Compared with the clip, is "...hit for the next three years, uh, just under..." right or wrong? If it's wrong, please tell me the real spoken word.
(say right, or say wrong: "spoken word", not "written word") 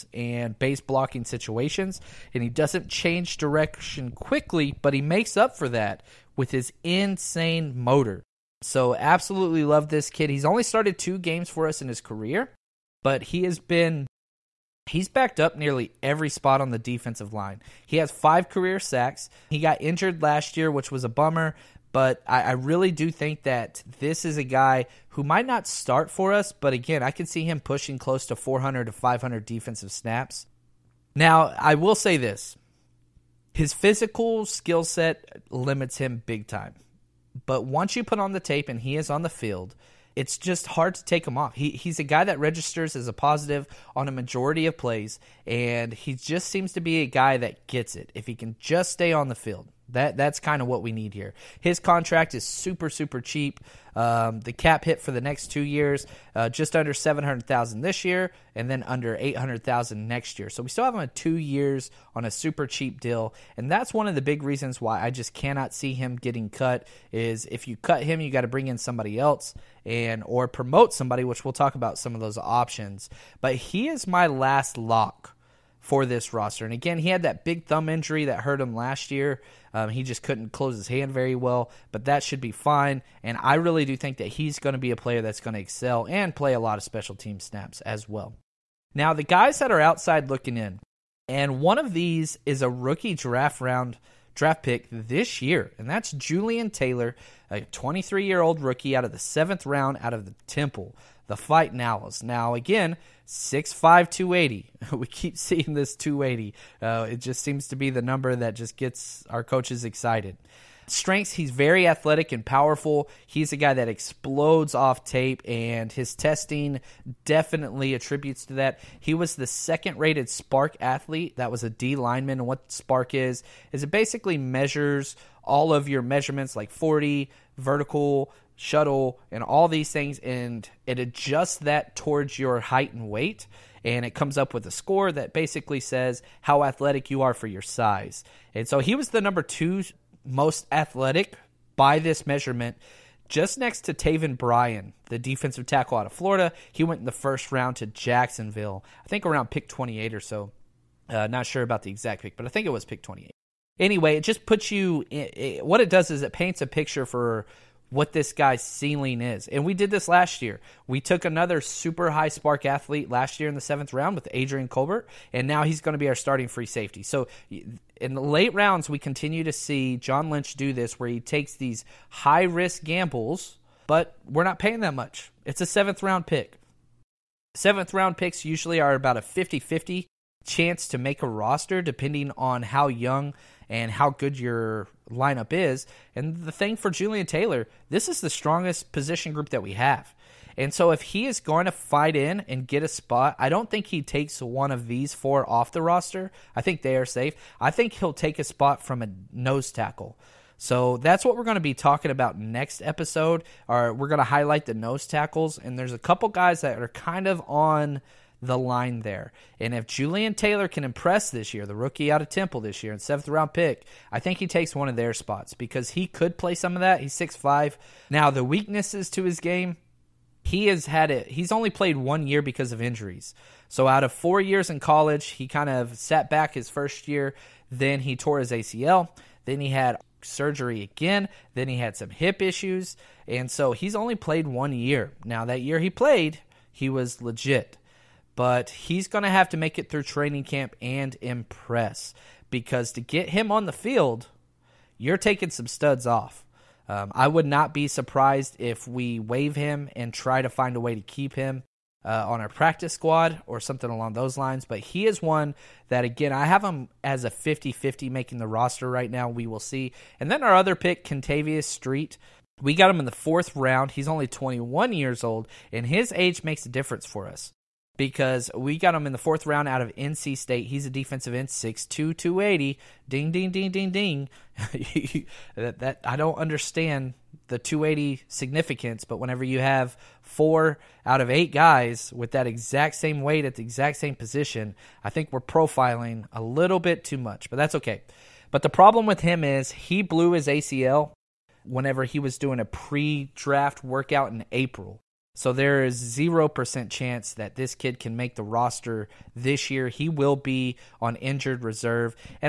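wrong: "two", not "three".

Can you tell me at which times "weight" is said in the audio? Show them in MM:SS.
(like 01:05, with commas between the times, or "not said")
02:13, 04:43.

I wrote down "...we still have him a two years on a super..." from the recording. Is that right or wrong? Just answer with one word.
right.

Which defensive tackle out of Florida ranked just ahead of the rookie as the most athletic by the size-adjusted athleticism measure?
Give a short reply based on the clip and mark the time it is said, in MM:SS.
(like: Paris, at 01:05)
Taven Bryan, at 02:23.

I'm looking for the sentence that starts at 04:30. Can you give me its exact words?
He's a defensive end, 6'2", 280.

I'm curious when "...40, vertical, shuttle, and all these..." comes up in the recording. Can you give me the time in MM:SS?
02:06.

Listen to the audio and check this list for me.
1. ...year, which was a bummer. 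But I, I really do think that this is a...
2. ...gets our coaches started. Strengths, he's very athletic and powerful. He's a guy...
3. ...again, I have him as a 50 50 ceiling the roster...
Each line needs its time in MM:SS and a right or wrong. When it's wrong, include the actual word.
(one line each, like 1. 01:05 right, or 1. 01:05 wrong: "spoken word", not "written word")
1. 00:20 right
2. 01:48 wrong: "excited", not "started"
3. 04:16 wrong: "making", not "ceiling".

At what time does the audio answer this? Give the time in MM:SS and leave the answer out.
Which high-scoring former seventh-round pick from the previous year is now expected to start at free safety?
02:44.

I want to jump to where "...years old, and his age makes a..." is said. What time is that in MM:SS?
04:24.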